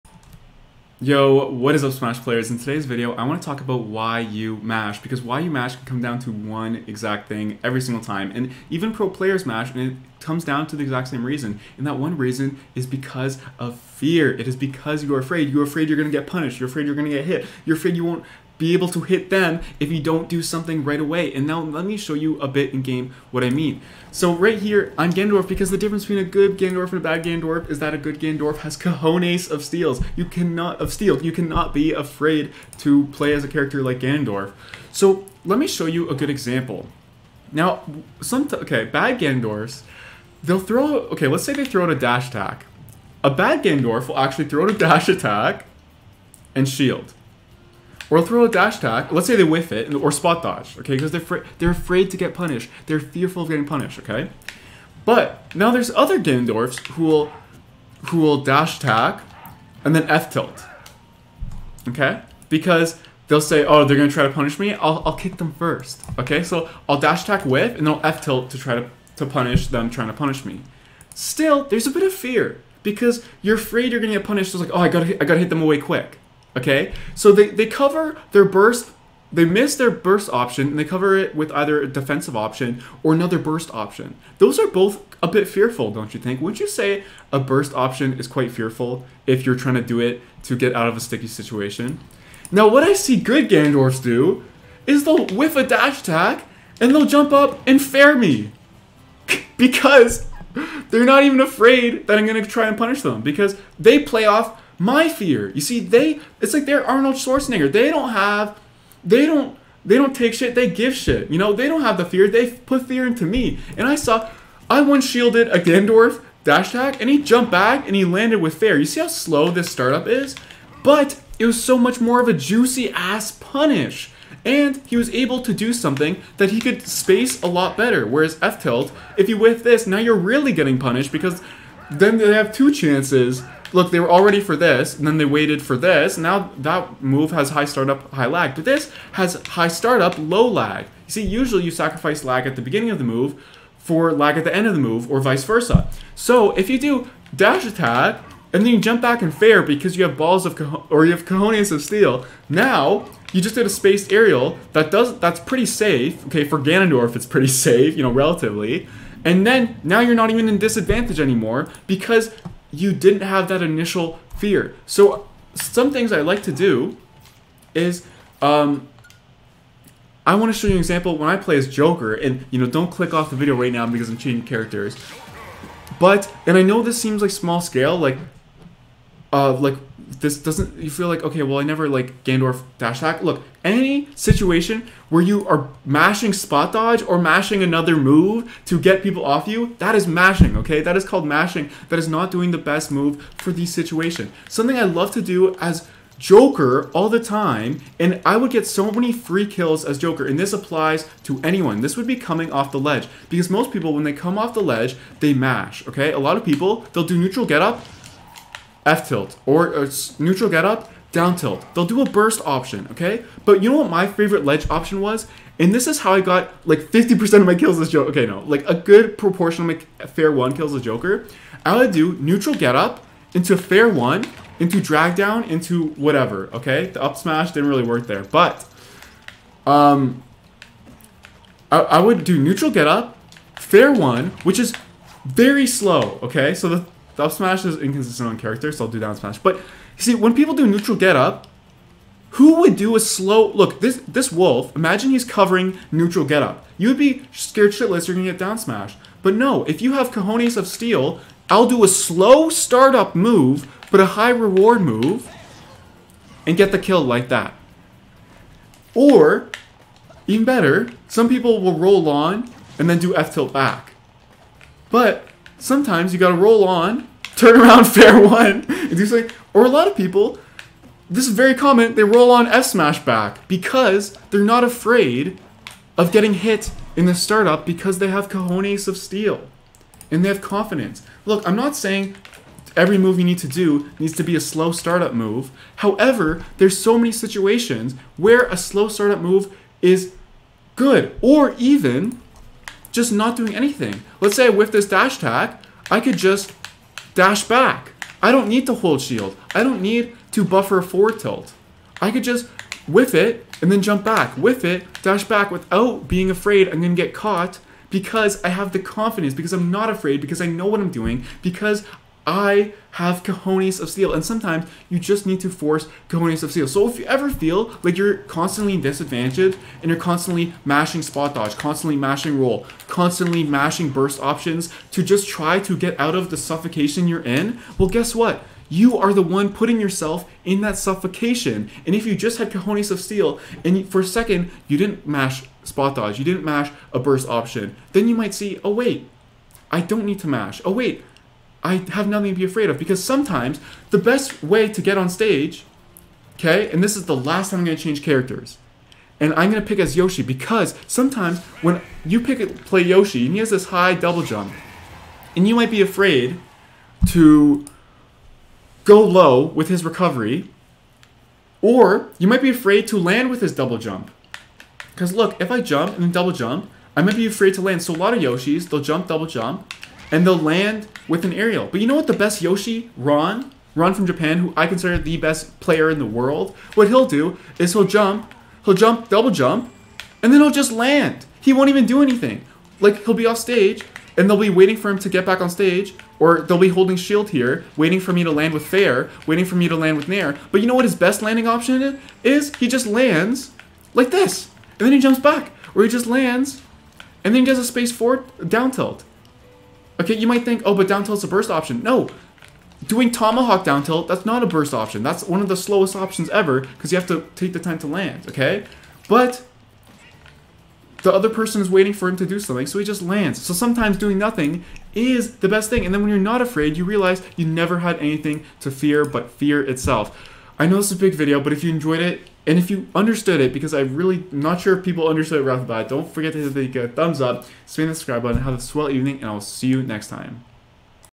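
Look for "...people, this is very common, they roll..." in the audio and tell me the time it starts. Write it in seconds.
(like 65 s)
269 s.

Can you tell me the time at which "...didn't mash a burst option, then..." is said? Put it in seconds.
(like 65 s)
336 s.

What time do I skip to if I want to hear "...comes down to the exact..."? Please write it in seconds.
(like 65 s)
10 s.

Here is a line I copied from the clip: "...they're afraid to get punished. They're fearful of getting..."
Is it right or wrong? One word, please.
right.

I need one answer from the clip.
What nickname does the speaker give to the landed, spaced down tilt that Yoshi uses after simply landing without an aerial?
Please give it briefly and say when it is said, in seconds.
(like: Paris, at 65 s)
tomahawk down tilt, at 403 s.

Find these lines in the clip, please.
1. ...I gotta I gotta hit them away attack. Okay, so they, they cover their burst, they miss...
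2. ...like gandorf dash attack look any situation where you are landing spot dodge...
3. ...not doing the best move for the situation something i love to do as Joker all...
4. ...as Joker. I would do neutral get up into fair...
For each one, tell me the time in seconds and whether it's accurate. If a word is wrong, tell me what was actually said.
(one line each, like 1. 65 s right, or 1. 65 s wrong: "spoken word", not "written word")
1. 74 s wrong: "quick", not "attack"
2. 181 s wrong: "mashing", not "landing"
3. 192 s right
4. 220 s right.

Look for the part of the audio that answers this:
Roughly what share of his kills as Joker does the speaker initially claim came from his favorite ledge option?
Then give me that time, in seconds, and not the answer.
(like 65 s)
216 s.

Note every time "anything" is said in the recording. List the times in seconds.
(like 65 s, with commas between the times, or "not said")
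293 s, 382 s, 417 s.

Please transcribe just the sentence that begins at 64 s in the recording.
I'll I'll kick them first, okay?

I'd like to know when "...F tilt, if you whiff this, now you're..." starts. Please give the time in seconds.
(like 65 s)
128 s.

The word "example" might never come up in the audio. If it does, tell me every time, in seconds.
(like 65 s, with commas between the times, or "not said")
36 s, 170 s.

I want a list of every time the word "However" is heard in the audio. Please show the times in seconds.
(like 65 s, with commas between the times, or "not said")
285 s.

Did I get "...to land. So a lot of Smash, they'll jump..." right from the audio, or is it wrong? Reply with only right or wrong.
wrong.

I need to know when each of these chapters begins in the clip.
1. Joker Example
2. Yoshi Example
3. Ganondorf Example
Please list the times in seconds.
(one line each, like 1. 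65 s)
1. 180 s
2. 350 s
3. 40 s.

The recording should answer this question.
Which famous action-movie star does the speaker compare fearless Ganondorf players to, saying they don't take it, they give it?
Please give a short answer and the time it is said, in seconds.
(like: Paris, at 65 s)
Arnold Schwarzenegger, at 106 s.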